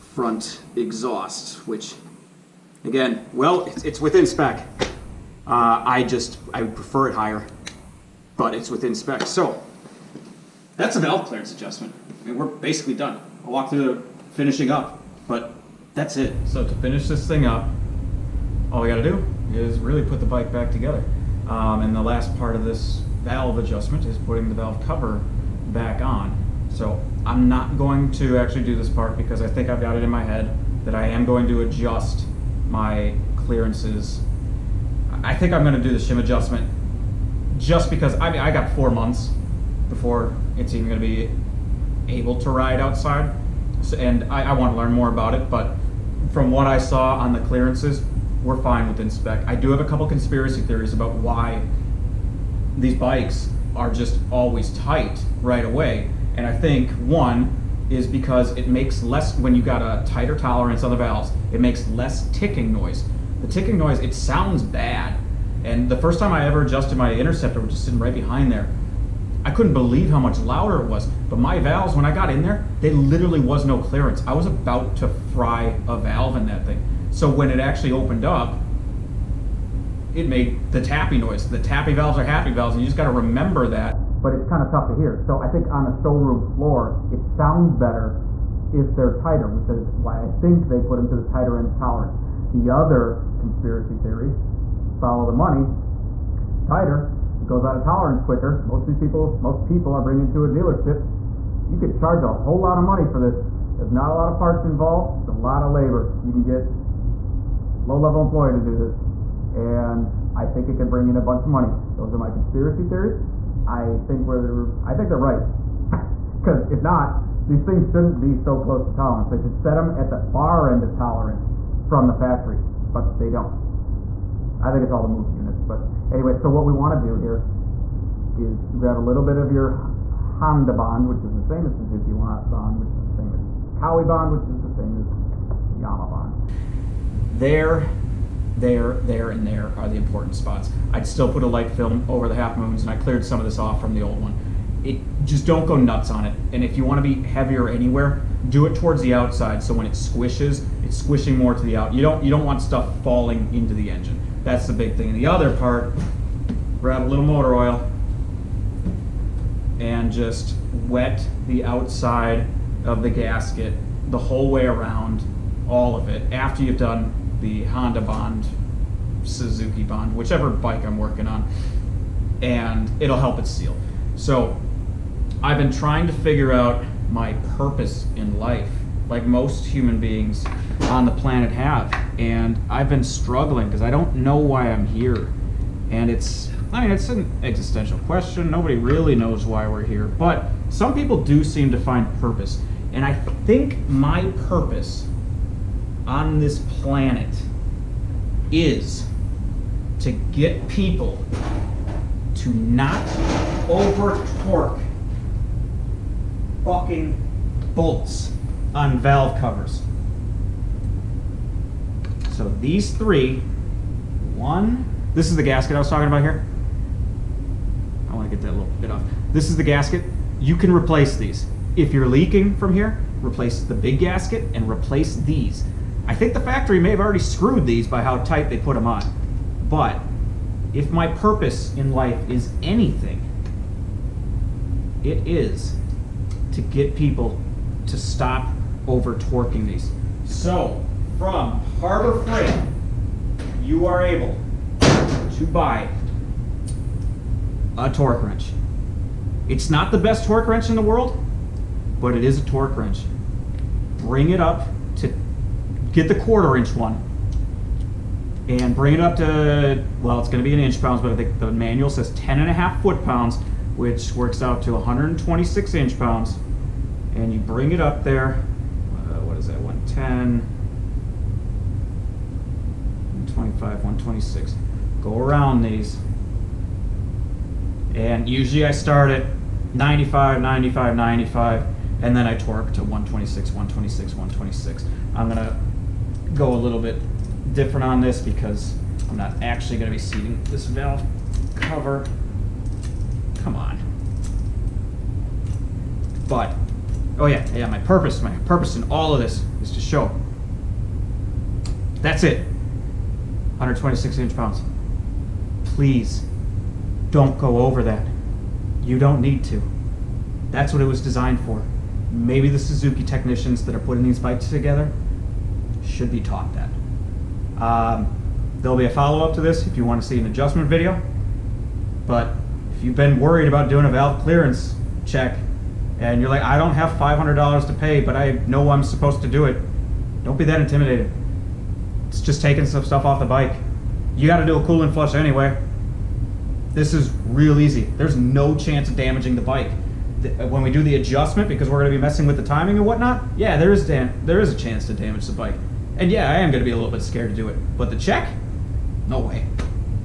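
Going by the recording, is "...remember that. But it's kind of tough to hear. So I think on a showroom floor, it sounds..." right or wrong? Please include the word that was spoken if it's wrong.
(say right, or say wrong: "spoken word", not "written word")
right.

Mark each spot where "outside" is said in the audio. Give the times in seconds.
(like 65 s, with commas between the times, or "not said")
42 s, 149 s, 161 s.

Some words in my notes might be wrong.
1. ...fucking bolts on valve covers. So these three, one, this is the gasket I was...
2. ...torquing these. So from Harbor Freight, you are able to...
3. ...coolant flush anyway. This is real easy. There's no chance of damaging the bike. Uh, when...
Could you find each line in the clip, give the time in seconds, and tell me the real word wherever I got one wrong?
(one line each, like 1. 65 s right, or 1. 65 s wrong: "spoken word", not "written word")
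1. 206 s right
2. 239 s right
3. 334 s right.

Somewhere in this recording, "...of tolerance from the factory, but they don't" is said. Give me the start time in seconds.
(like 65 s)
120 s.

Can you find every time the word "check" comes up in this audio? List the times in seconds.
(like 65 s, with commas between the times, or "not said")
325 s, 347 s.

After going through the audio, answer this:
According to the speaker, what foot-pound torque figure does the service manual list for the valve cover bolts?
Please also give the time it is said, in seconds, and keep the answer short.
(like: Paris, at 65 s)
10.5 foot pounds, at 262 s.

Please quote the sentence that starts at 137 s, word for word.
There, there, there, and there are the important spots.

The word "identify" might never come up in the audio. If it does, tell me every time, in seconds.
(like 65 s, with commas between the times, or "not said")
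not said.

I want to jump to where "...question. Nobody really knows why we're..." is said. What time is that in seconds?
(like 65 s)
187 s.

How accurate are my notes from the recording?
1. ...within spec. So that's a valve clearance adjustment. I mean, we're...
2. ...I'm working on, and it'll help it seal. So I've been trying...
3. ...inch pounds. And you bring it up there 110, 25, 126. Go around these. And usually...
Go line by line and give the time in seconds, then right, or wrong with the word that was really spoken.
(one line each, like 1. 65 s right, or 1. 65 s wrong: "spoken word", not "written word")
1. 8 s right
2. 170 s right
3. 265 s right.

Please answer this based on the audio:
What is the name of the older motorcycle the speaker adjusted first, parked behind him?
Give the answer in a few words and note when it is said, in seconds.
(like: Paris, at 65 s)
Interceptor, at 67 s.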